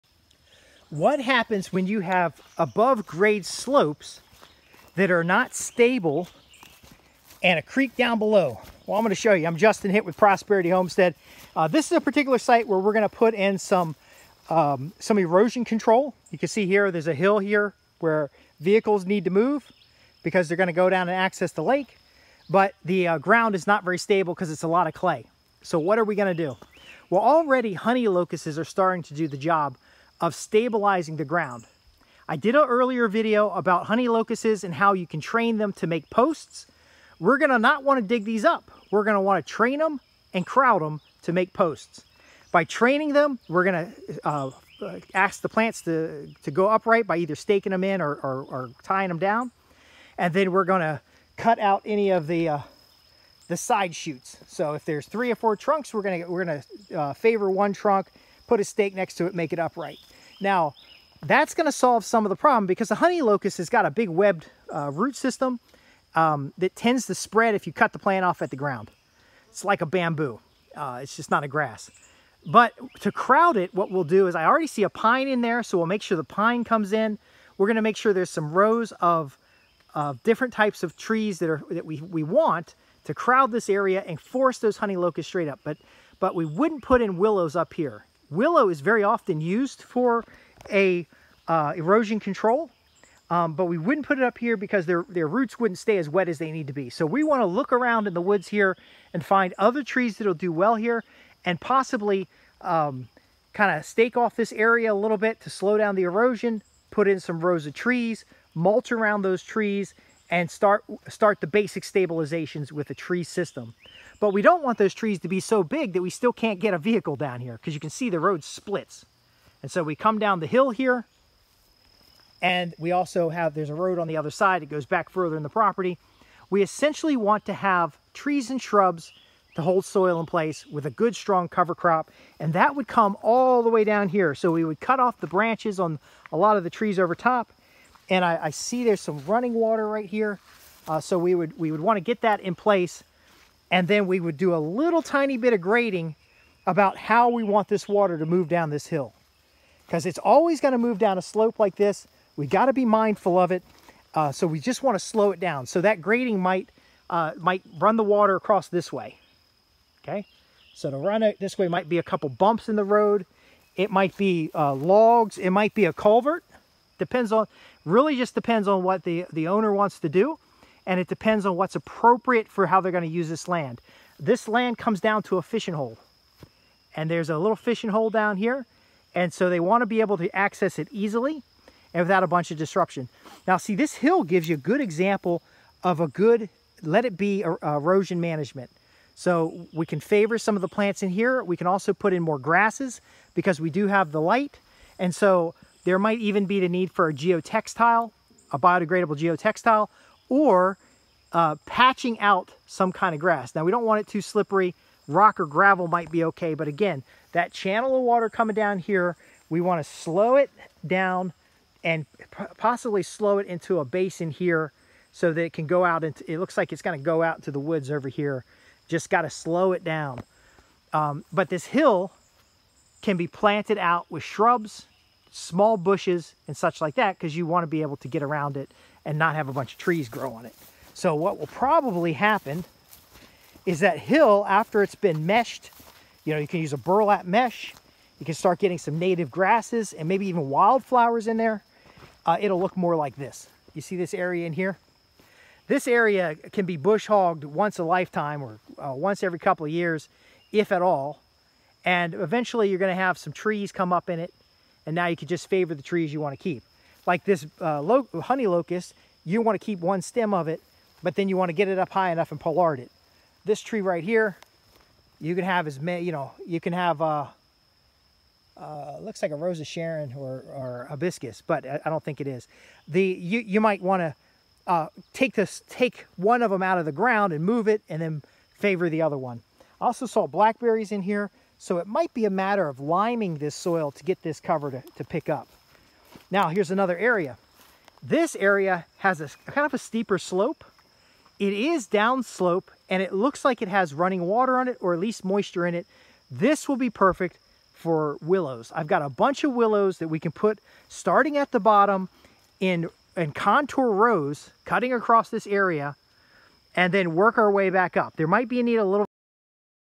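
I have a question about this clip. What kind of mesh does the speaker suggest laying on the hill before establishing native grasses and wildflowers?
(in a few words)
Burlap mesh.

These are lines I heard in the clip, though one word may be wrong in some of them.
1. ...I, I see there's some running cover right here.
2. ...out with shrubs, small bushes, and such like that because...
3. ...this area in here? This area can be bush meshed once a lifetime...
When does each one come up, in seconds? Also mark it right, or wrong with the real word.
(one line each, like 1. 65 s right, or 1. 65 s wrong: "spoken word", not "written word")
1. 138 s wrong: "water", not "cover"
2. 223 s right
3. 243 s wrong: "hogged", not "meshed".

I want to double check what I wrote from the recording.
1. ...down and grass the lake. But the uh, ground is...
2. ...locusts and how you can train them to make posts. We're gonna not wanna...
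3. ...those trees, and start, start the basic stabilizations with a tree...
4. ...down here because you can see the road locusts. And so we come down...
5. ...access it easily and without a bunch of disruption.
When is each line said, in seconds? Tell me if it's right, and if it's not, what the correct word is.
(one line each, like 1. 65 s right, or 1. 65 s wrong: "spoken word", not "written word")
1. 20 s wrong: "access", not "grass"
2. 34 s right
3. 109 s right
4. 117 s wrong: "splits", not "locusts"
5. 180 s right.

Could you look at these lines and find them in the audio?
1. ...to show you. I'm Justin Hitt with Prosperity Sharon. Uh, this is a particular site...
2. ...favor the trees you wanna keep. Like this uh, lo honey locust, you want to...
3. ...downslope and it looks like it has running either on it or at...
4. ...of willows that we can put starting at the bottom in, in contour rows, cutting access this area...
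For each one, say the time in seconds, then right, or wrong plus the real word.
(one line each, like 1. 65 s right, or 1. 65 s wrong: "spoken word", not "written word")
1. 9 s wrong: "Homestead", not "Sharon"
2. 255 s right
3. 291 s wrong: "water", not "either"
4. 299 s wrong: "across", not "access".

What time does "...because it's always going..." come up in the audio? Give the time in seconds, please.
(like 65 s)
149 s.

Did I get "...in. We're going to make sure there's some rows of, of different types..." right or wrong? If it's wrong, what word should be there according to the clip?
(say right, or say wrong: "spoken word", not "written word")
right.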